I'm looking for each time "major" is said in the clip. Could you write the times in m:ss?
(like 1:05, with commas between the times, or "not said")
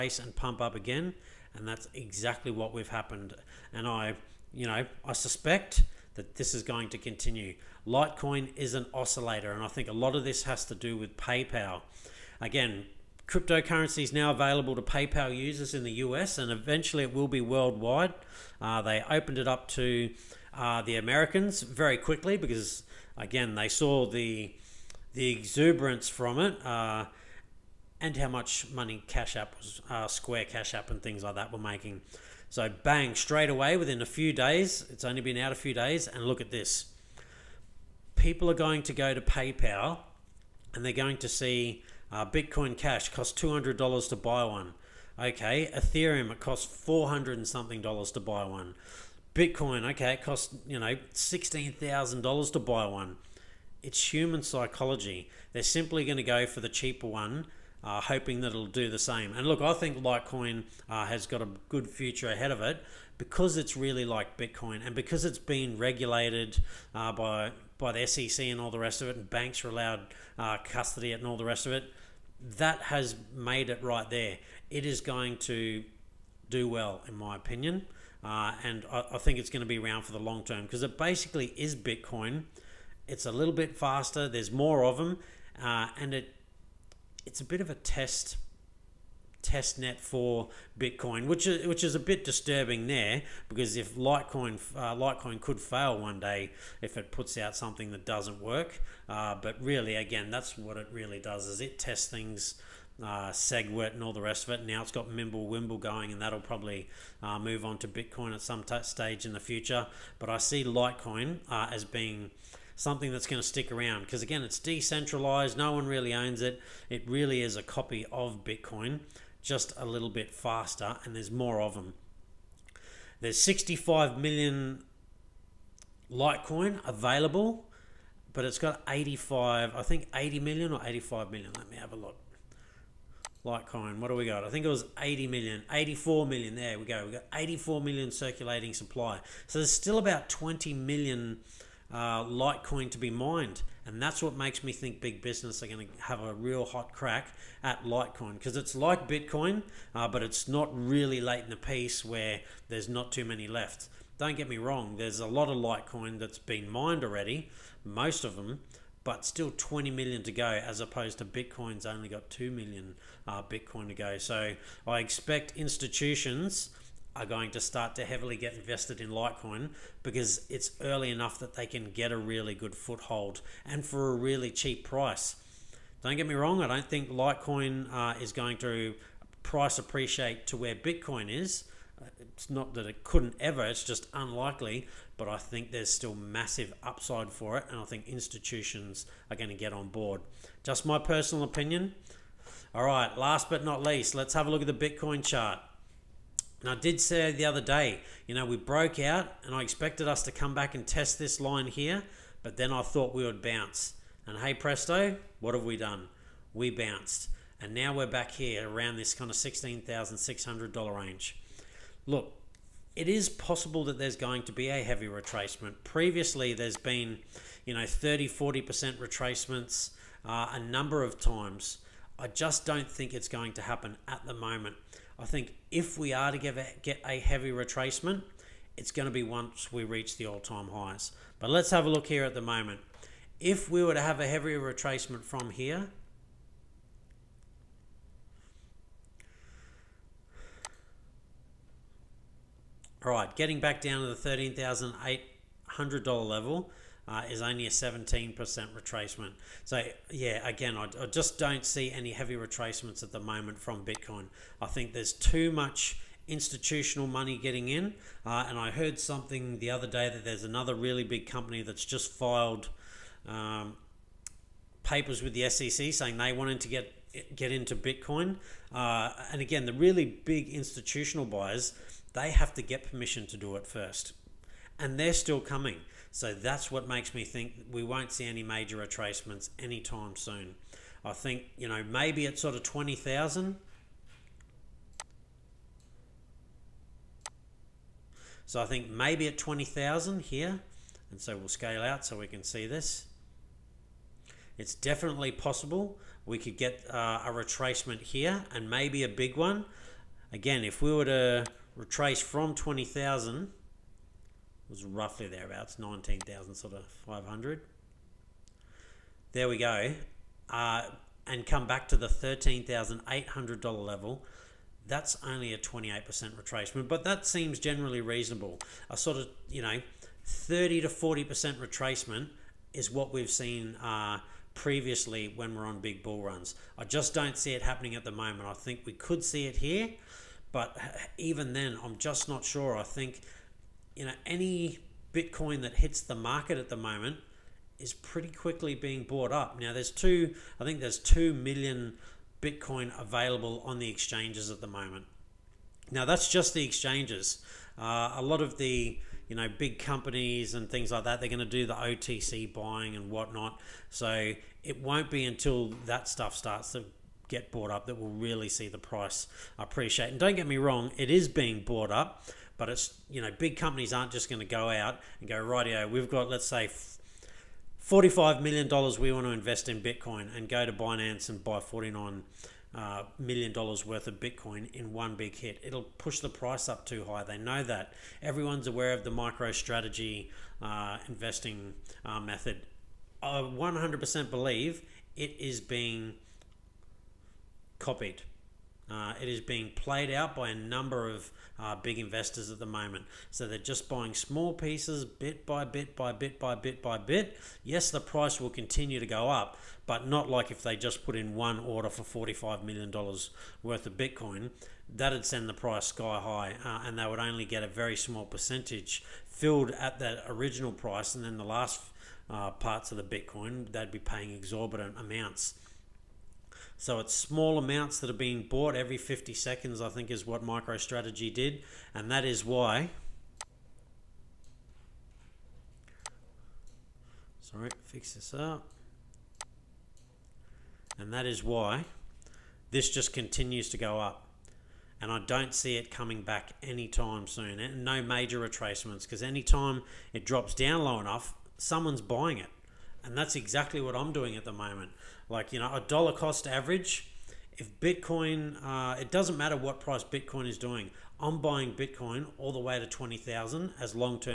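4:38, 7:18.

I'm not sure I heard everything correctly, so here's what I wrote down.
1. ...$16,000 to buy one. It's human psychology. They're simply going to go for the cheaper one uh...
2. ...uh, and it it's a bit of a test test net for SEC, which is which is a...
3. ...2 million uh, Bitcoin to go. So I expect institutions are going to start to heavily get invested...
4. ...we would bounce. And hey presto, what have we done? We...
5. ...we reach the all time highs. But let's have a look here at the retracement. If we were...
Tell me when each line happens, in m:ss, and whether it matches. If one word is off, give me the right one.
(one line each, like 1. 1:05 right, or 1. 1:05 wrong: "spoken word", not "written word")
1. 0:51 right
2. 1:25 wrong: "Bitcoin", not "SEC"
3. 2:42 right
4. 3:23 right
5. 3:49 wrong: "moment", not "retracement".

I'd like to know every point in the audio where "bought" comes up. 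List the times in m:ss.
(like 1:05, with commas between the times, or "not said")
5:39, 5:57, 6:01, 6:58.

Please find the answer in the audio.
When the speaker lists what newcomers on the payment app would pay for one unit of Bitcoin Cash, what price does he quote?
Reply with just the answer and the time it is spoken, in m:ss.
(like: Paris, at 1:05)
$200, at 0:43.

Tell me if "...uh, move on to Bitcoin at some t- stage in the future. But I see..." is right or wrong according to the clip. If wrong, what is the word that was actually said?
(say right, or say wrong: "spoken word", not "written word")
right.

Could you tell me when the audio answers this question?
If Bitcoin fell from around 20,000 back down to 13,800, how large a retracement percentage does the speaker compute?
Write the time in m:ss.
5:15.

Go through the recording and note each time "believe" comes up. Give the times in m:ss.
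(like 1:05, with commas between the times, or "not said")
6:24.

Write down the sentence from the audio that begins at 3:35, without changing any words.
Previously, there's been, you know, 30, 40% retracements uh, a number of times.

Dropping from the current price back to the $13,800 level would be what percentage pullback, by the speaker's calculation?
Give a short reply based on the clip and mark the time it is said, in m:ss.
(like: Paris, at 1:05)
17%, at 4:07.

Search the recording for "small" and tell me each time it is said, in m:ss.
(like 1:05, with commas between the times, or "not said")
6:34, 6:47, 6:57.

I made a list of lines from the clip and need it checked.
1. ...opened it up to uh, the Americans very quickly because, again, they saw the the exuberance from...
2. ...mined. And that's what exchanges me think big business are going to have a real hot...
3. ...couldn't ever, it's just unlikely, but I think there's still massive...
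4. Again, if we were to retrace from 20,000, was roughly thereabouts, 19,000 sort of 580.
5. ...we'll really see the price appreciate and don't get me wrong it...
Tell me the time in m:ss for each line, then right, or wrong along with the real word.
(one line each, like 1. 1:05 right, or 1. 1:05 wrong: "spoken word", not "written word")
1. 0:19 right
2. 2:23 wrong: "makes", not "exchanges"
3. 3:03 right
4. 5:00 wrong: "500", not "580"
5. 5:57 right.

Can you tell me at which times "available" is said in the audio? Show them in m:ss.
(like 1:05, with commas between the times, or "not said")
0:14, 2:06, 5:43.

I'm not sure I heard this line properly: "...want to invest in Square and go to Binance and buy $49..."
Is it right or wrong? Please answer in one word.
wrong.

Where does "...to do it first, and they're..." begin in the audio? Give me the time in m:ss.
4:33.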